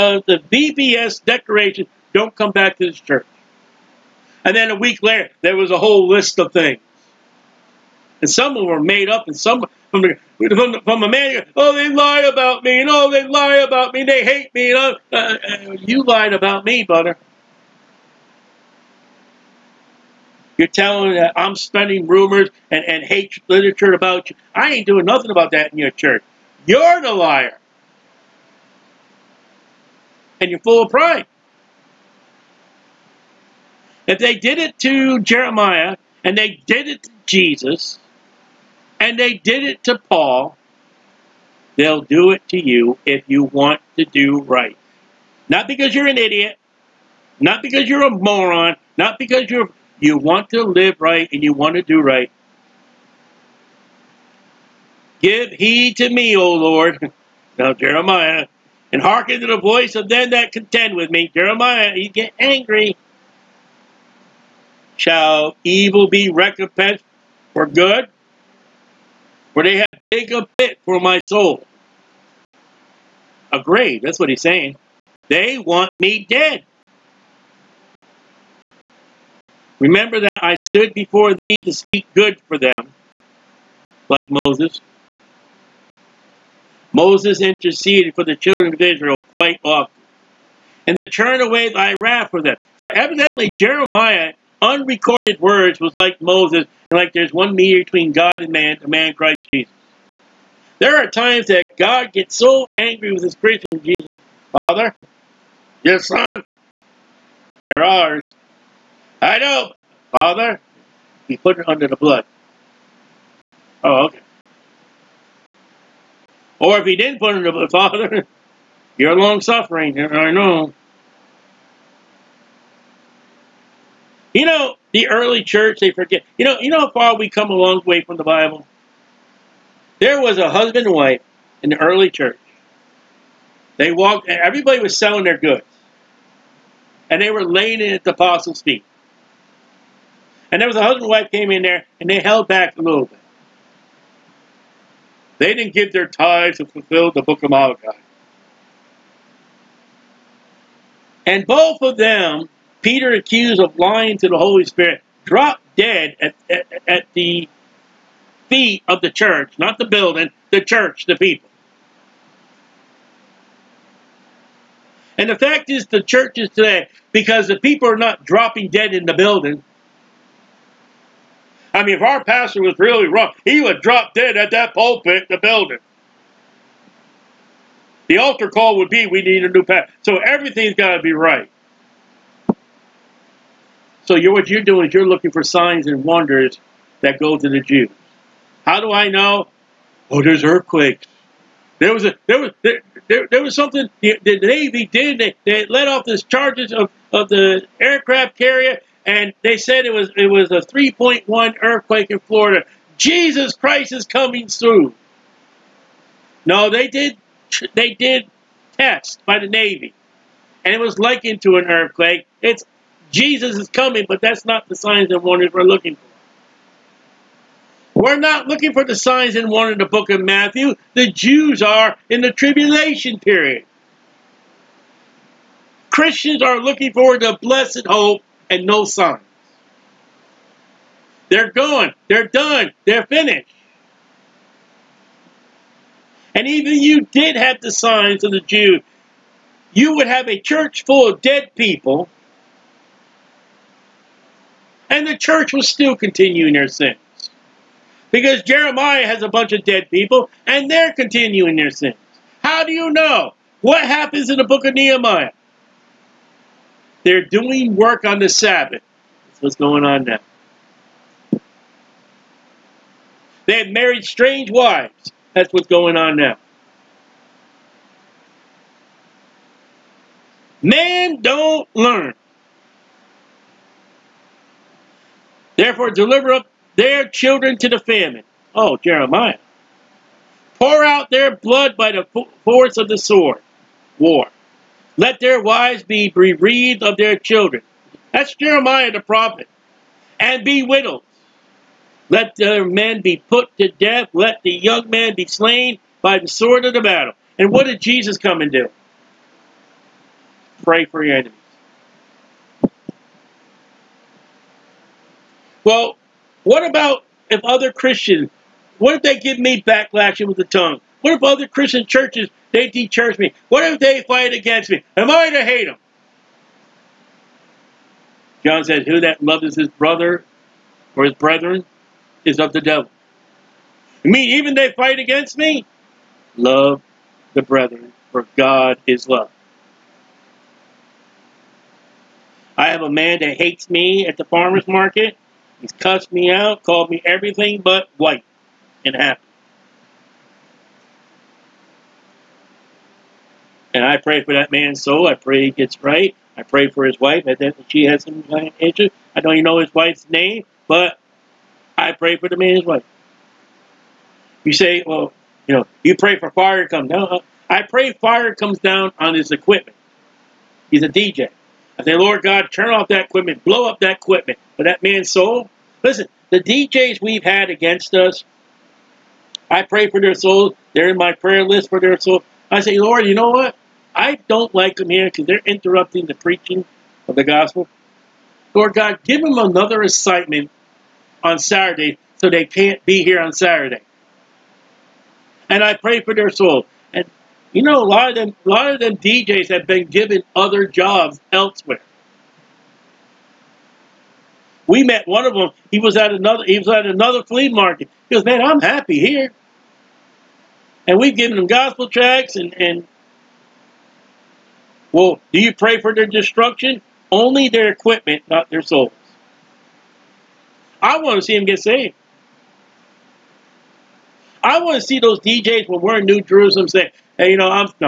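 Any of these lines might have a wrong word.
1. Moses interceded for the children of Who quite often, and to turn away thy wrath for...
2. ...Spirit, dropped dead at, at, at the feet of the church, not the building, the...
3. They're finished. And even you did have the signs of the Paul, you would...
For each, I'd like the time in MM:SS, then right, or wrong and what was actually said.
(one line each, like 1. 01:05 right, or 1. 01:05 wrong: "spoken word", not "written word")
1. 01:26 wrong: "Israel", not "Who"
2. 02:34 right
3. 03:52 wrong: "Jews", not "Paul".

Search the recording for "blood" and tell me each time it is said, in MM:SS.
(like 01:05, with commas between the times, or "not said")
01:51, 01:57, 04:41.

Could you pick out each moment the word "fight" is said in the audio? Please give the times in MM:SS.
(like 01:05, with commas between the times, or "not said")
05:14, 05:24.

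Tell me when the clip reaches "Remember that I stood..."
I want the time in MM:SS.
01:19.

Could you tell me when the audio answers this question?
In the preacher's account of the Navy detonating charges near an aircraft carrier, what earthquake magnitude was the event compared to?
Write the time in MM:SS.
03:20.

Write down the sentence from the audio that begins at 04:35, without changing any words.
Therefore, deliver up their children to the famine.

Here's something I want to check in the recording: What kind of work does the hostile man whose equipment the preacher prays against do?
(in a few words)
DJ.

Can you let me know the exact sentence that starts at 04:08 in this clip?
Because Jeremiah has a bunch of dead people, and they're continuing their sins.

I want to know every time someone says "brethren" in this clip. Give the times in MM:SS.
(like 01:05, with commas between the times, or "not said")
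05:21, 05:27.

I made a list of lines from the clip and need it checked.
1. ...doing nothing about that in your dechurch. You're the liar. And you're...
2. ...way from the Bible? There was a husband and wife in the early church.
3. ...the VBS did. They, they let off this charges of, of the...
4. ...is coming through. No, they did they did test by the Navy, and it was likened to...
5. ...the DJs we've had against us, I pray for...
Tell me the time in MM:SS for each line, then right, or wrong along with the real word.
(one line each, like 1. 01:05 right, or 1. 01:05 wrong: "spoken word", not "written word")
1. 00:24 wrong: "church", not "dechurch"
2. 02:07 right
3. 03:14 wrong: "Navy", not "VBS"
4. 03:23 right
5. 06:06 right.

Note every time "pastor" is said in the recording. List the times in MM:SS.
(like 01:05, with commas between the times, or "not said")
02:52, 02:59.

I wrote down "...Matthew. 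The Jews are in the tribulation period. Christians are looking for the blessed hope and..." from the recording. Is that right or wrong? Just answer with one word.
right.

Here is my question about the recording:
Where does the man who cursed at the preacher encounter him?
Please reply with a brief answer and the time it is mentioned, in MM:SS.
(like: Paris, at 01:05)
the farmer's market, at 05:34.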